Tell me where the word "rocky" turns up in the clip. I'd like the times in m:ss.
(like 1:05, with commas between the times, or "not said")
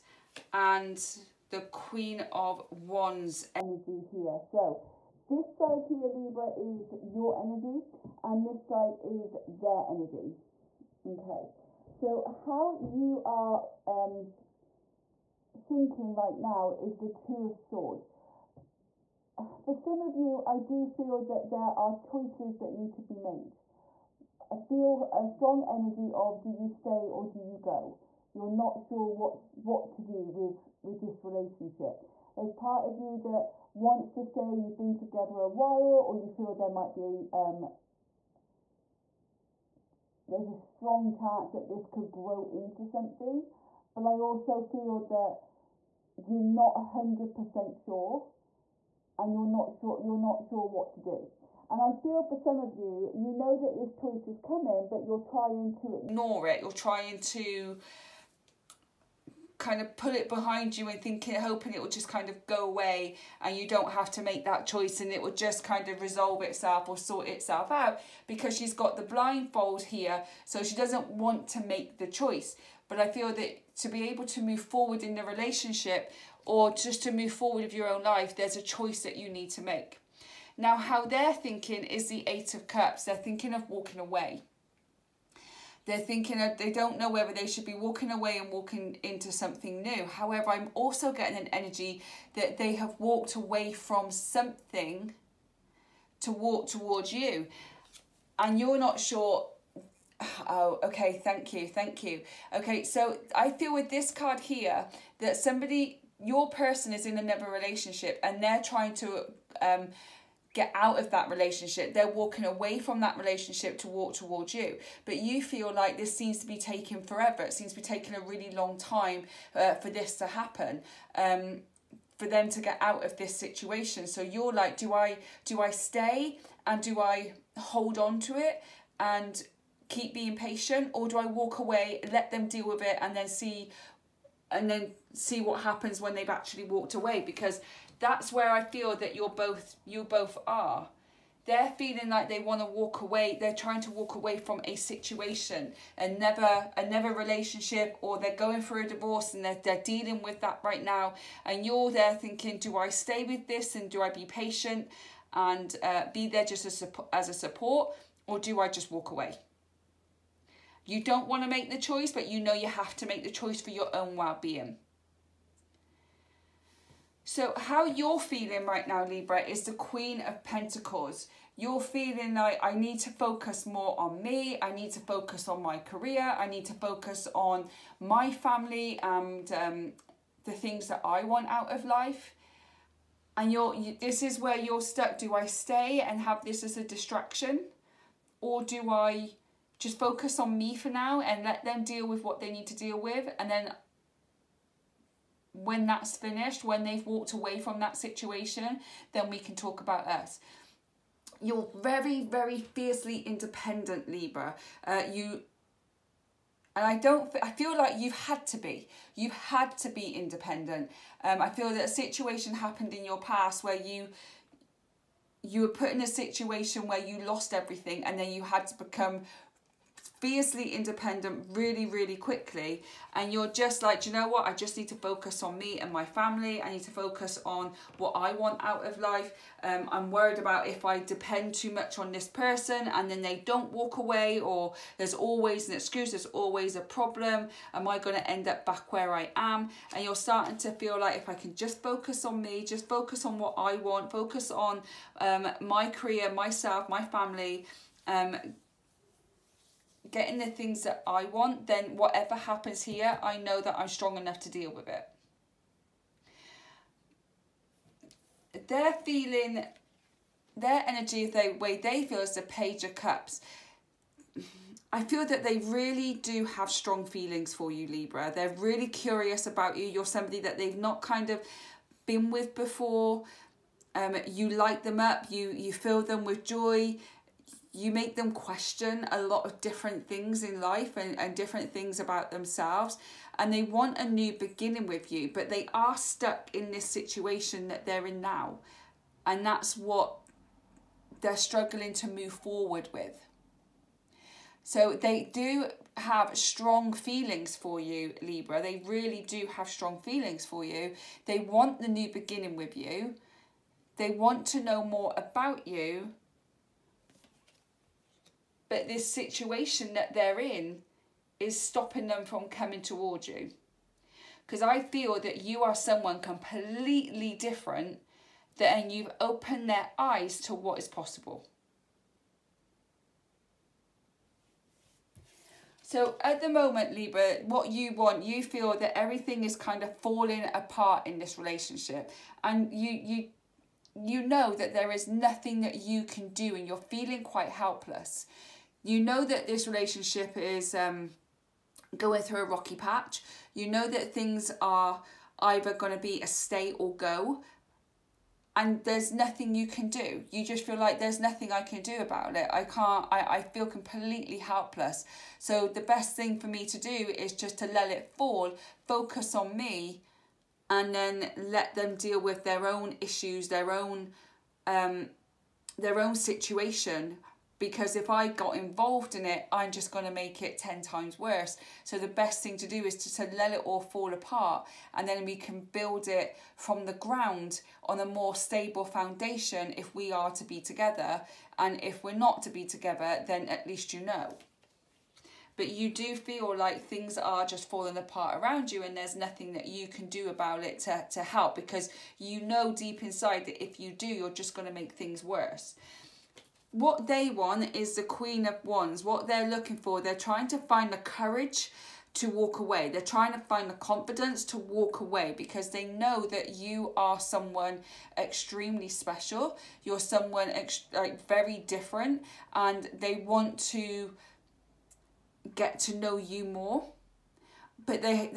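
5:42.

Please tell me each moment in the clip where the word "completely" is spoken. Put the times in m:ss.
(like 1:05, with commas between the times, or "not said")
5:16, 5:53.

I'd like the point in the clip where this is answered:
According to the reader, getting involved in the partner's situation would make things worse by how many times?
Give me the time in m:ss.
6:10.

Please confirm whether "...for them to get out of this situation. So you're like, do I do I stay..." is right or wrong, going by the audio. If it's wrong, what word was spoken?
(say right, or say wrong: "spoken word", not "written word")
right.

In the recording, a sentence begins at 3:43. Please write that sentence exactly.
And you're just like, you know what?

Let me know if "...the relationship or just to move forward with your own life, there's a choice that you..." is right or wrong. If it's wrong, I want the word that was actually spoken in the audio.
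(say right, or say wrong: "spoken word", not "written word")
right.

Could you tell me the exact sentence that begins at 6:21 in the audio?
And if we're not to be together, then at least you know.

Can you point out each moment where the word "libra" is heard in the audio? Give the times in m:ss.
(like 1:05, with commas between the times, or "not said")
0:06, 2:49, 3:24, 4:27, 4:58, 5:26.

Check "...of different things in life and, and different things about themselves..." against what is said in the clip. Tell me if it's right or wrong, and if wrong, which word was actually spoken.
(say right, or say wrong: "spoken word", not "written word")
right.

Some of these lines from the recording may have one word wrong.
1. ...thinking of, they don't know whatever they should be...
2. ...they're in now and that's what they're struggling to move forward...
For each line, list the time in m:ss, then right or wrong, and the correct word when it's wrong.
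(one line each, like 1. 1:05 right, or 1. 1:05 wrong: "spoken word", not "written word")
1. 1:25 wrong: "whether", not "whatever"
2. 4:47 right.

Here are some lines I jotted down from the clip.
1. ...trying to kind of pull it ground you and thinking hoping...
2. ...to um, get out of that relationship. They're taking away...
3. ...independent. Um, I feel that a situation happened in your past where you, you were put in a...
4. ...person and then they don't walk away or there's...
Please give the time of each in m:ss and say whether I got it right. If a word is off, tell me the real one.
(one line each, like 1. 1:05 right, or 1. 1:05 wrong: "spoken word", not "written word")
1. 0:56 wrong: "behind", not "ground"
2. 1:48 wrong: "walking", not "taking"
3. 3:30 right
4. 3:52 right.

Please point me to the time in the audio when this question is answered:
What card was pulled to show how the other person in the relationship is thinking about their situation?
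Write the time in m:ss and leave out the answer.
1:22.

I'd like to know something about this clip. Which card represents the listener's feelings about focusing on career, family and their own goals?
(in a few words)
Queen of Pentacles.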